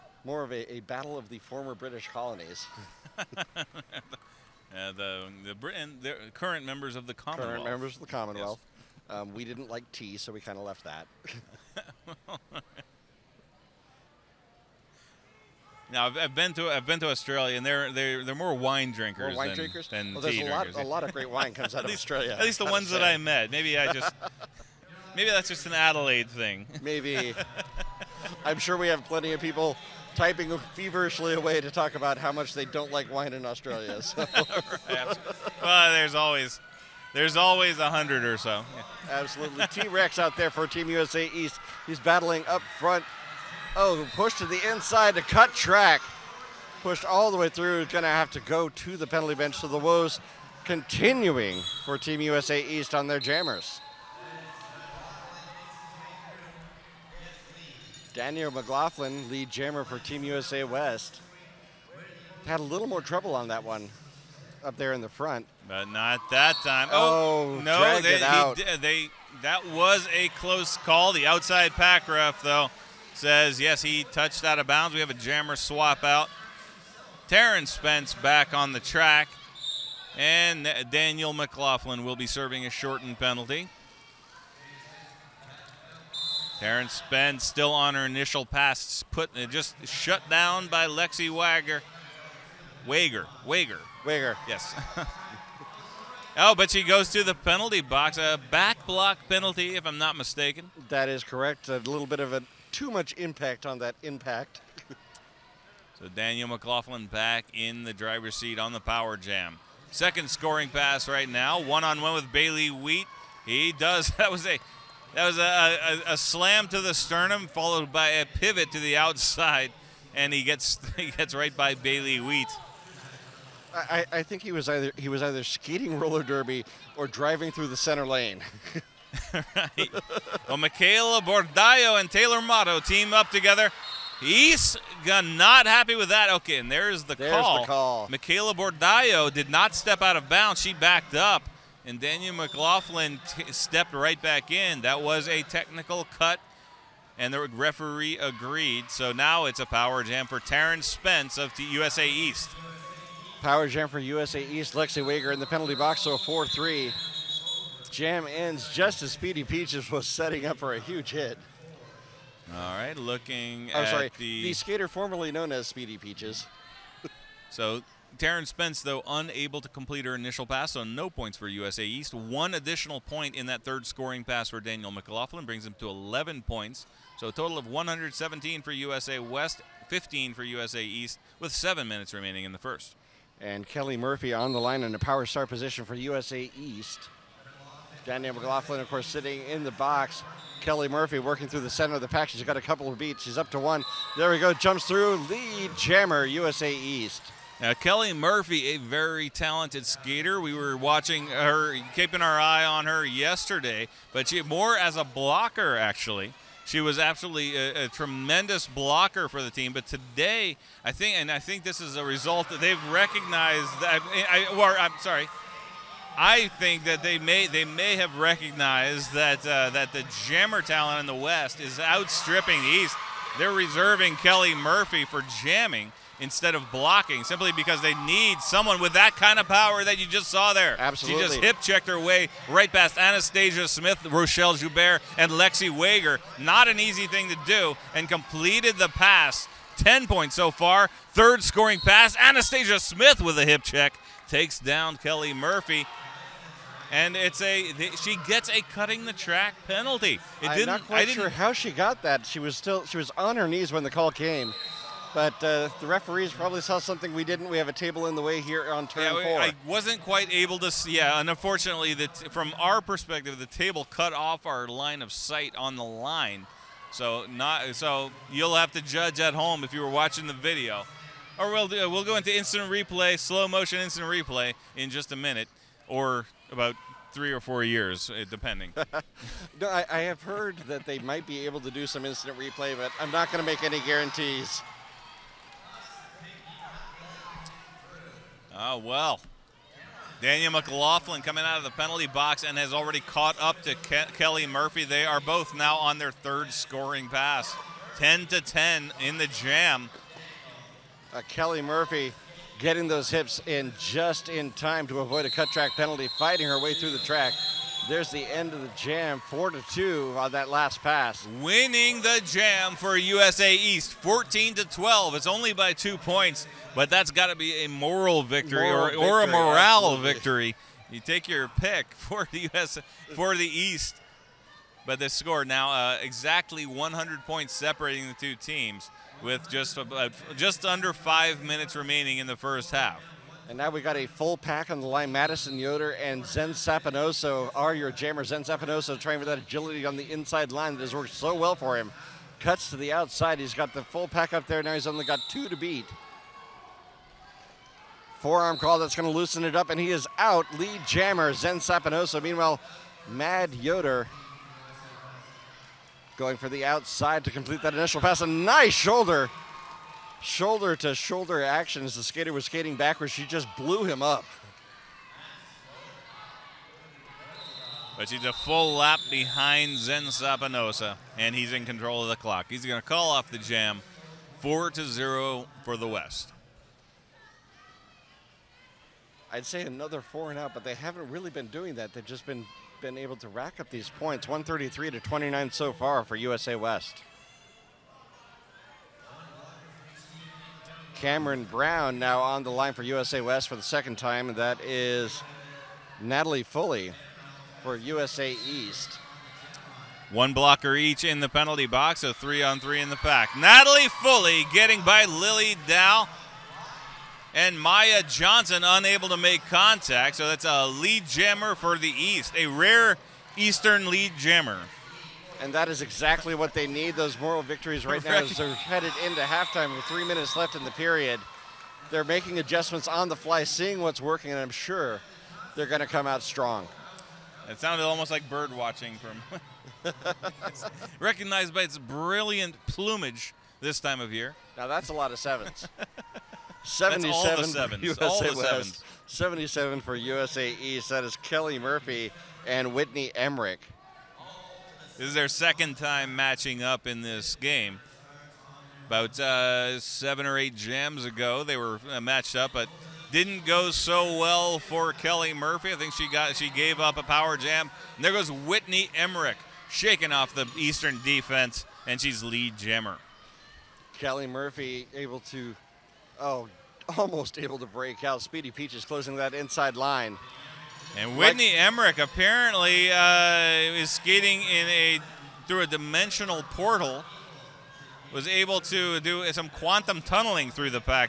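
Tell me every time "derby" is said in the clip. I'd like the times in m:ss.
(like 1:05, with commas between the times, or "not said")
2:06.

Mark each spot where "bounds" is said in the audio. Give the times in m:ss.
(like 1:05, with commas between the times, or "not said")
1:14, 2:20.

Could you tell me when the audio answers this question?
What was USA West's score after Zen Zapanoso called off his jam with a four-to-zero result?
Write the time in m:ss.
6:24.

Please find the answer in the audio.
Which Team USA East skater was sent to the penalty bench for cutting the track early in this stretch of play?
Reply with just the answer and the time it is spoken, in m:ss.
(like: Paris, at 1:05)
T Rex, at 0:39.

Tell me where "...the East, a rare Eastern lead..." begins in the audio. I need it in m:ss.
6:51.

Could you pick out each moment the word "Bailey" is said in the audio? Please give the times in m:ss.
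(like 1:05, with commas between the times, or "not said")
1:52, 2:01.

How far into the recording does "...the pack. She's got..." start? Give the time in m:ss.
3:12.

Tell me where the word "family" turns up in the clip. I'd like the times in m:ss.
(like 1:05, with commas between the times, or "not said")
not said.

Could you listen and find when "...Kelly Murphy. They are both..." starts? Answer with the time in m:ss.
4:54.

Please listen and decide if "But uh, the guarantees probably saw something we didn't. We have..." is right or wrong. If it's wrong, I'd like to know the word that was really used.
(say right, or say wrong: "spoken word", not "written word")
wrong: "referees", not "guarantees".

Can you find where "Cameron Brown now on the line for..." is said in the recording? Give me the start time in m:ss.
6:30.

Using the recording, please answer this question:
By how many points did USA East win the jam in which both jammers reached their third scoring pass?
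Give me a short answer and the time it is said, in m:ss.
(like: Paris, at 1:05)
2, at 5:15.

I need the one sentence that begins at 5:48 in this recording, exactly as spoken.
Forearm call that's going to loosen it up, and he is out.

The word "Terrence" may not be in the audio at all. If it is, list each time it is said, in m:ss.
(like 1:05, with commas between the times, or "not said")
1:17, 1:26, 2:30.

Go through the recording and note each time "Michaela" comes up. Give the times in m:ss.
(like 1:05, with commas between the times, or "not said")
2:10, 2:18.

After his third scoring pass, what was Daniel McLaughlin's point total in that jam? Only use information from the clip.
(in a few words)
11.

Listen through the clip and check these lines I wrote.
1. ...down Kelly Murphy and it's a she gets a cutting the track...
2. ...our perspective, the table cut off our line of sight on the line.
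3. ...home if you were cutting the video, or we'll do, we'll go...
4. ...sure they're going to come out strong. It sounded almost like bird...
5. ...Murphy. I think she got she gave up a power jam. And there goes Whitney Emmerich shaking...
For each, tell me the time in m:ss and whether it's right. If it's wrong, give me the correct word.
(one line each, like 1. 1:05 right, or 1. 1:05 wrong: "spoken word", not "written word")
1. 4:04 right
2. 4:22 right
3. 4:29 wrong: "watching", not "cutting"
4. 7:04 right
5. 7:35 right.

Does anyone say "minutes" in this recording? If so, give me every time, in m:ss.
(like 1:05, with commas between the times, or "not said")
3:01, 4:35, 5:31, 7:00.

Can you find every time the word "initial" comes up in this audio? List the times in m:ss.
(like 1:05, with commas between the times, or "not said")
1:28, 2:50, 5:57.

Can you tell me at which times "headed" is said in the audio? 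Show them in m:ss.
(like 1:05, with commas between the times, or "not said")
6:58.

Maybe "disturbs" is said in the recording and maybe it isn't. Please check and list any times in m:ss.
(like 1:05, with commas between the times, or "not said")
not said.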